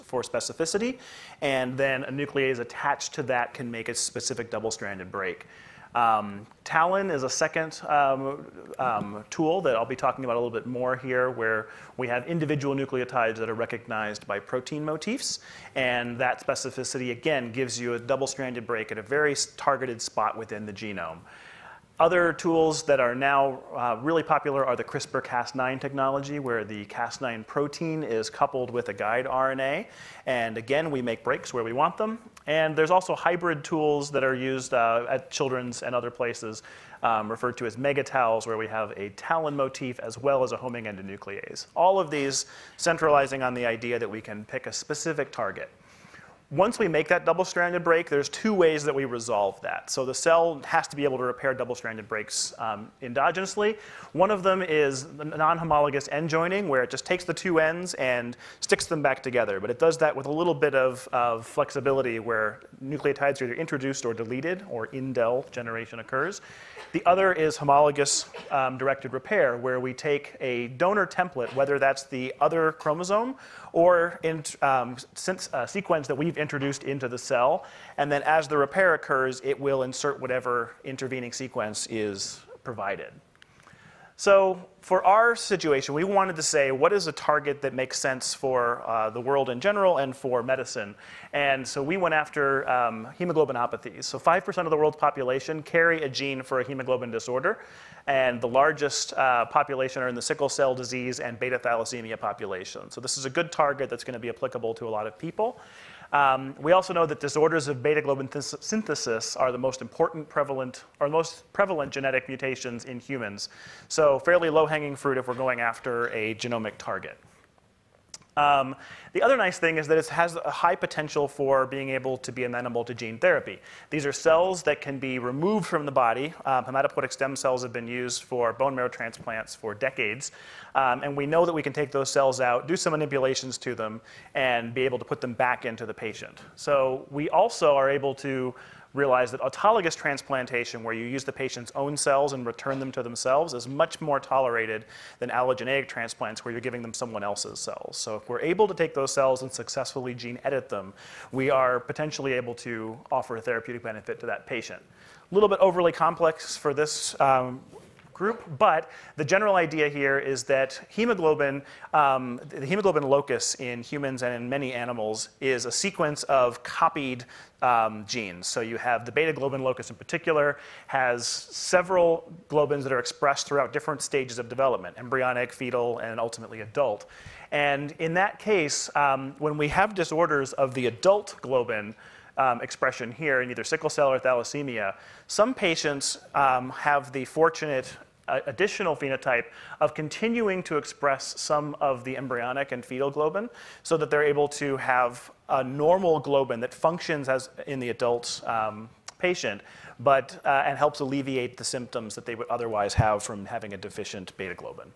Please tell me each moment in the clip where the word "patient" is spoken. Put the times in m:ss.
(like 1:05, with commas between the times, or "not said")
2:15, 2:21, 2:34, 3:05, 3:19.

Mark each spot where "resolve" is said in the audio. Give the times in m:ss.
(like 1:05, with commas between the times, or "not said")
0:49.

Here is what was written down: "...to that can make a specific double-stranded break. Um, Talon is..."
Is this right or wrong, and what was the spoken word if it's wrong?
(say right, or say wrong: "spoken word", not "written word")
right.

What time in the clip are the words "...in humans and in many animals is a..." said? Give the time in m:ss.
2:43.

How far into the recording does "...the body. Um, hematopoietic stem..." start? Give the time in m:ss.
2:05.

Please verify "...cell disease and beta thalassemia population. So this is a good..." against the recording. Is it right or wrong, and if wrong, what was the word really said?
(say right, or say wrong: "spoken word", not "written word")
right.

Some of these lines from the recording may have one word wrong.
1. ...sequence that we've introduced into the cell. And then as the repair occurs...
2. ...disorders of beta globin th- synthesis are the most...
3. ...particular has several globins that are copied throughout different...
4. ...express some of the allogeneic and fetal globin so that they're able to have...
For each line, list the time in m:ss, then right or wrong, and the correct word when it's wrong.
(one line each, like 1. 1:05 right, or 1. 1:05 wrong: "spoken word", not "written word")
1. 1:15 right
2. 1:47 right
3. 2:49 wrong: "expressed", not "copied"
4. 3:10 wrong: "embryonic", not "allogeneic".